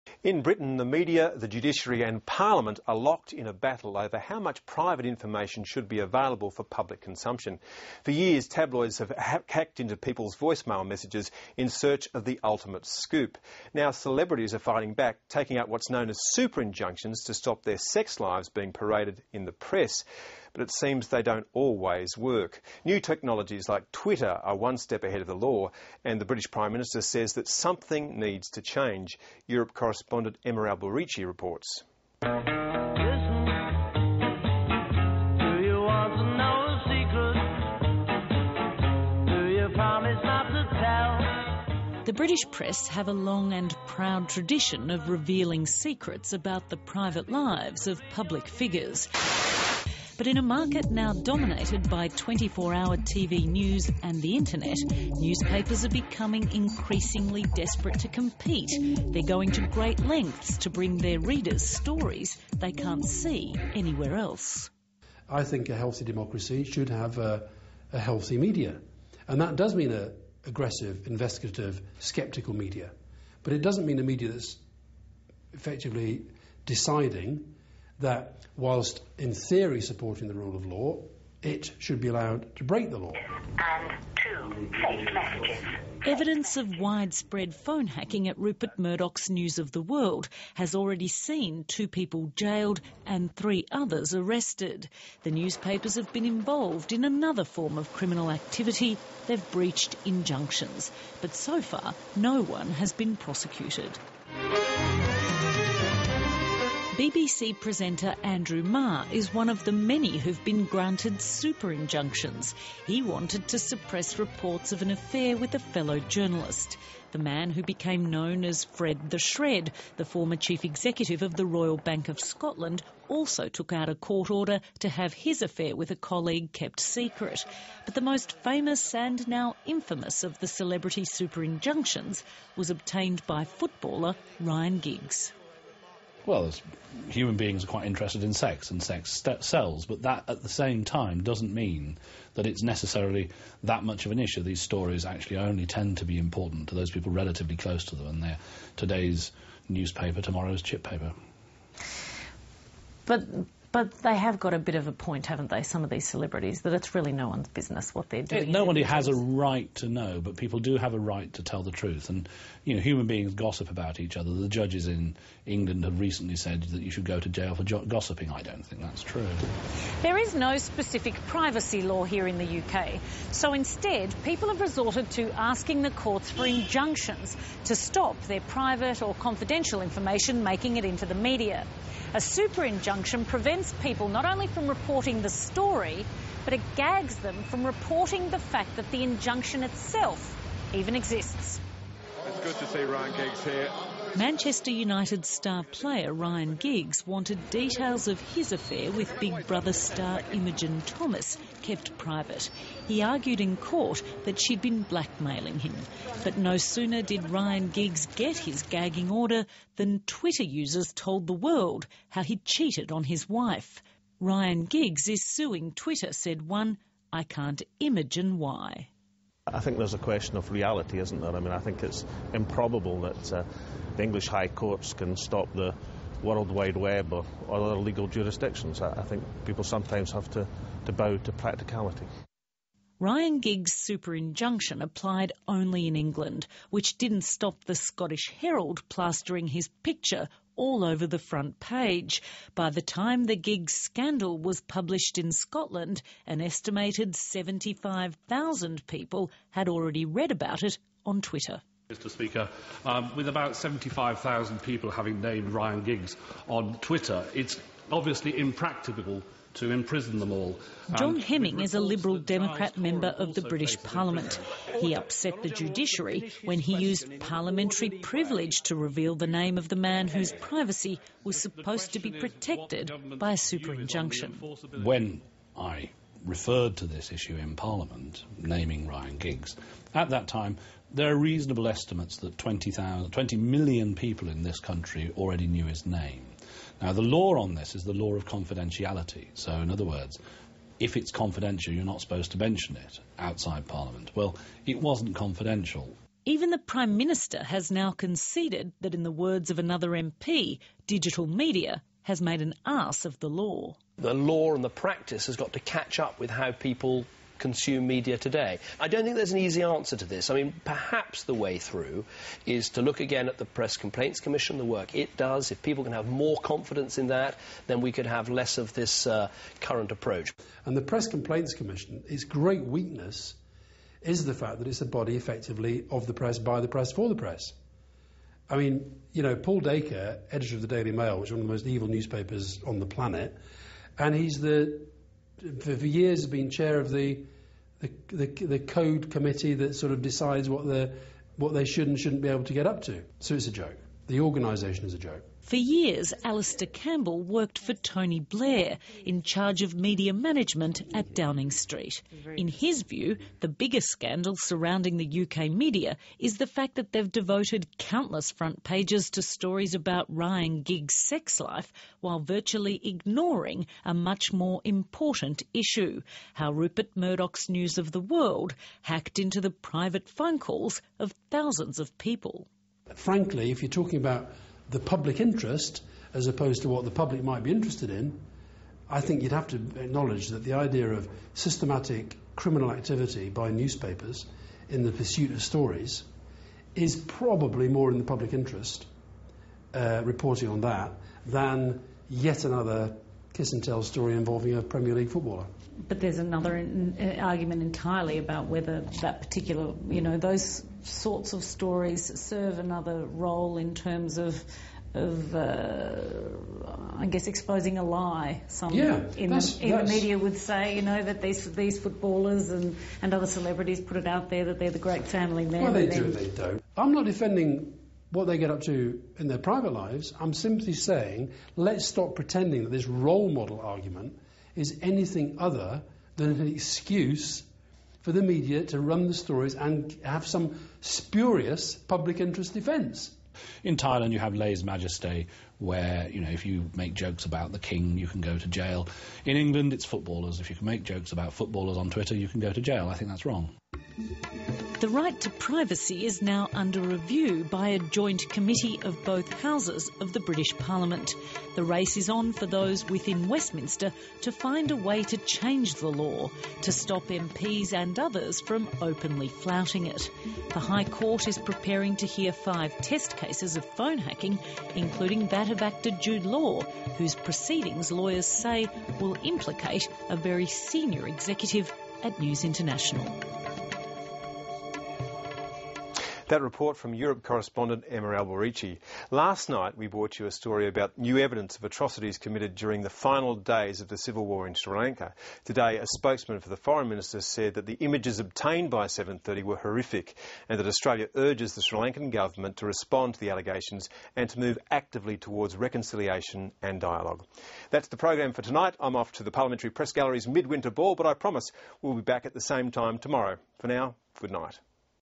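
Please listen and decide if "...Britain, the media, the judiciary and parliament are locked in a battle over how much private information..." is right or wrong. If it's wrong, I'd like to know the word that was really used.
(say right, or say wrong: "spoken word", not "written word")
right.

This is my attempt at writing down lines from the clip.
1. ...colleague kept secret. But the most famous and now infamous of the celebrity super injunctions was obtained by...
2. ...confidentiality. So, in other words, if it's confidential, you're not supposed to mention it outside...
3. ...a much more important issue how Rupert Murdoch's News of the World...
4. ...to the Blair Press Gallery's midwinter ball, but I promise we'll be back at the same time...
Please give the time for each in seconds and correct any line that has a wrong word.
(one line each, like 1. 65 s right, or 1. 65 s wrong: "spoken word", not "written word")
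1. 125 s right
2. 288 s right
3. 363 s right
4. 499 s wrong: "Parliamentary", not "Blair".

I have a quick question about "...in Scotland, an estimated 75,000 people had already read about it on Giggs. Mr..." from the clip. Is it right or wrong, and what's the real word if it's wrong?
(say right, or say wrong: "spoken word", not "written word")
wrong: "Twitter", not "Giggs".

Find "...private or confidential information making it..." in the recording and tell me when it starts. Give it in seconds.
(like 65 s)
178 s.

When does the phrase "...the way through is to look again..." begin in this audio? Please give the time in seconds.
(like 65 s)
311 s.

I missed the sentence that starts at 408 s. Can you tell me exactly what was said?
Some yeah, in, that's, the, in that's...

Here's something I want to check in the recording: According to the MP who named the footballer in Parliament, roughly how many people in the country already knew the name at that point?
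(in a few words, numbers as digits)
20 million.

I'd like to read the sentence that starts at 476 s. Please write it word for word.
That report from Europe correspondent Emma Alberici.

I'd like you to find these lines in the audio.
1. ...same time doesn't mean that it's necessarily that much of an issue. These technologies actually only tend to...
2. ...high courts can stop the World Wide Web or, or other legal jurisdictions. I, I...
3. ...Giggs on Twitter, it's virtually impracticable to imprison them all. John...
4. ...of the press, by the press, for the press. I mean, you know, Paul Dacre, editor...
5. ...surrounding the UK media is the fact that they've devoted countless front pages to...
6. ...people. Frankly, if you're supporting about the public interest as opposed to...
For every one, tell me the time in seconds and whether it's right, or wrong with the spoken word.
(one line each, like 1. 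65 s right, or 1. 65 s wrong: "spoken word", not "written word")
1. 140 s wrong: "stories", not "technologies"
2. 224 s right
3. 255 s wrong: "obviously", not "virtually"
4. 325 s right
5. 354 s right
6. 371 s wrong: "talking", not "supporting".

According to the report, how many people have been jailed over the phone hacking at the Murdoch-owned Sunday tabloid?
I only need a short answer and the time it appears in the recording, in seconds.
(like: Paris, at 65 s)
2, at 91 s.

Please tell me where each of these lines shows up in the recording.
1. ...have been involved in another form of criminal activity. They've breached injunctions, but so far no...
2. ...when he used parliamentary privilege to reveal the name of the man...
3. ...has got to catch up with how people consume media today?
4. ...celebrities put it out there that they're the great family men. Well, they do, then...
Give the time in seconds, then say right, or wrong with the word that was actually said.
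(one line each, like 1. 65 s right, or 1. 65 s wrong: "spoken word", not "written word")
1. 95 s right
2. 266 s right
3. 305 s right
4. 413 s right.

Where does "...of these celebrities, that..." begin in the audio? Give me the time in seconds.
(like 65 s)
155 s.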